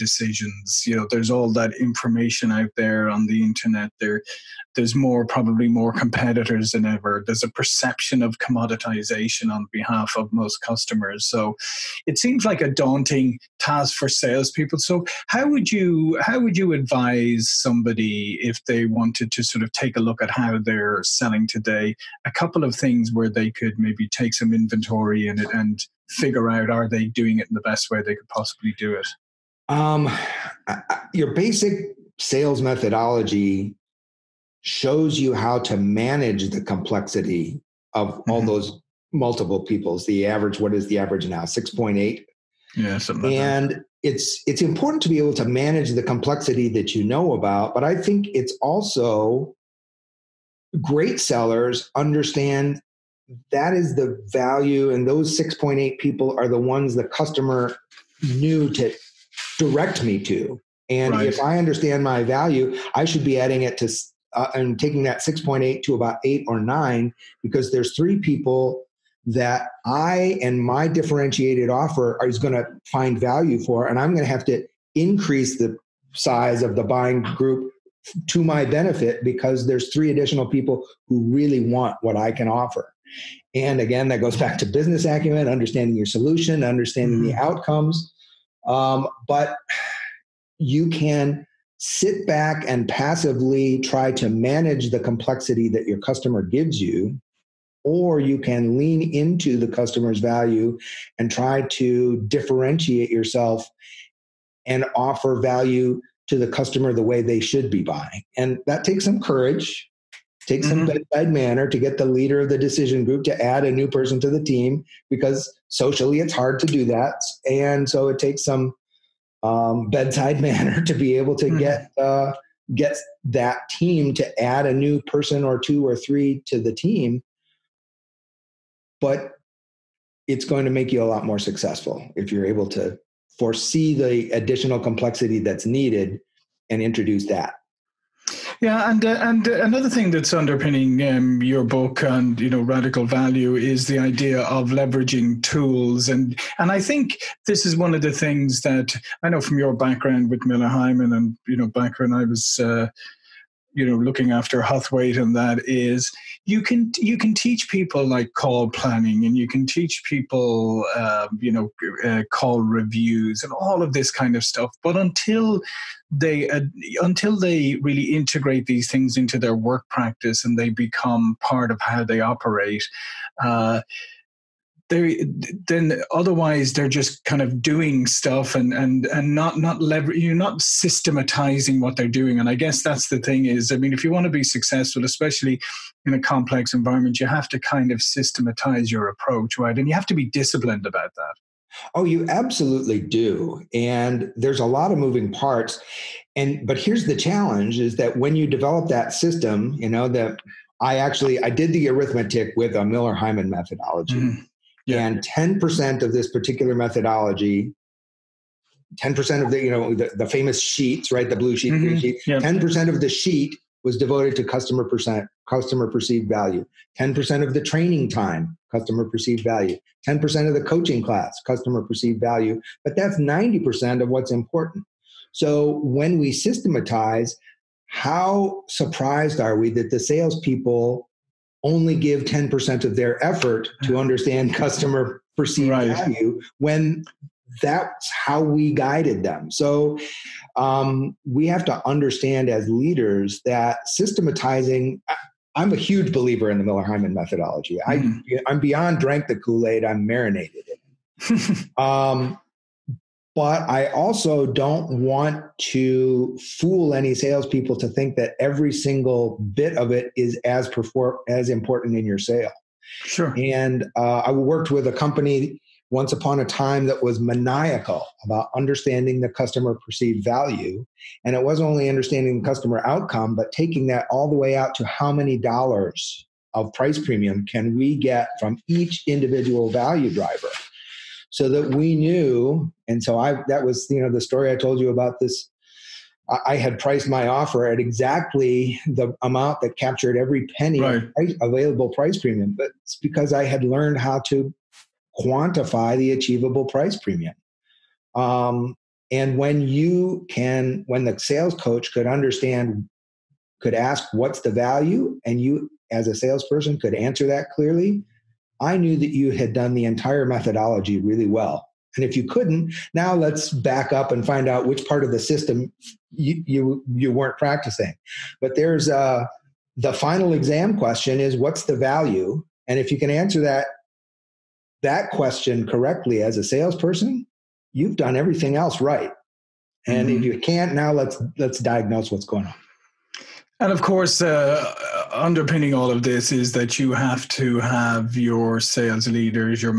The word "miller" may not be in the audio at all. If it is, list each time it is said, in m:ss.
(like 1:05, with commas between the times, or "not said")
2:30, 3:22, 4:06.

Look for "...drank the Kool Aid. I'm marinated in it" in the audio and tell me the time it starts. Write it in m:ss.
4:08.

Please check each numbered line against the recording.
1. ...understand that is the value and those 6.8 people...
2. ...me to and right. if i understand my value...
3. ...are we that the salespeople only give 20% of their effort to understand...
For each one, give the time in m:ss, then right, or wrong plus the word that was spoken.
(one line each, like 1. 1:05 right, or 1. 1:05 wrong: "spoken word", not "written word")
1. 0:51 right
2. 1:00 right
3. 3:49 wrong: "10", not "20".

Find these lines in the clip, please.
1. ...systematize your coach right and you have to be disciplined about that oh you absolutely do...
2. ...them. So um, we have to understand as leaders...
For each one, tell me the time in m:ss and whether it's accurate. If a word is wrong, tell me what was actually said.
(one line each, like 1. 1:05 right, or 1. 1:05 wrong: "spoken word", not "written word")
1. 3:08 wrong: "approach", not "coach"
2. 3:59 right.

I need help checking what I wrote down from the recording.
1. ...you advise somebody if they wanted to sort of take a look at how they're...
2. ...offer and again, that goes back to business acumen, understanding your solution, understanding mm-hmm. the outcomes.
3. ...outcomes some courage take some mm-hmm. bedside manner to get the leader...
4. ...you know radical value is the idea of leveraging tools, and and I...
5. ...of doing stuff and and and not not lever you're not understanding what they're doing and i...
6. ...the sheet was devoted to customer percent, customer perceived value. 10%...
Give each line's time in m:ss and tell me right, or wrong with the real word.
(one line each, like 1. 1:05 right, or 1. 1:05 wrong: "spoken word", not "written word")
1. 0:16 right
2. 1:22 right
3. 1:48 wrong: "takes", not "outcomes"
4. 2:22 right
5. 2:57 wrong: "systematizing", not "understanding"
6. 3:33 right.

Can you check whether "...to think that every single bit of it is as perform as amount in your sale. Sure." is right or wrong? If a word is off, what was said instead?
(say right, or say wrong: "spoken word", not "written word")
wrong: "important", not "amount".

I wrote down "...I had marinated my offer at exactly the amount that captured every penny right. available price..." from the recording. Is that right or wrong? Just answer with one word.
wrong.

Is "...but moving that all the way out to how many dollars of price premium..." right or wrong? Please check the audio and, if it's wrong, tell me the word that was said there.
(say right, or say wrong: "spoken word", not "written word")
wrong: "taking", not "moving".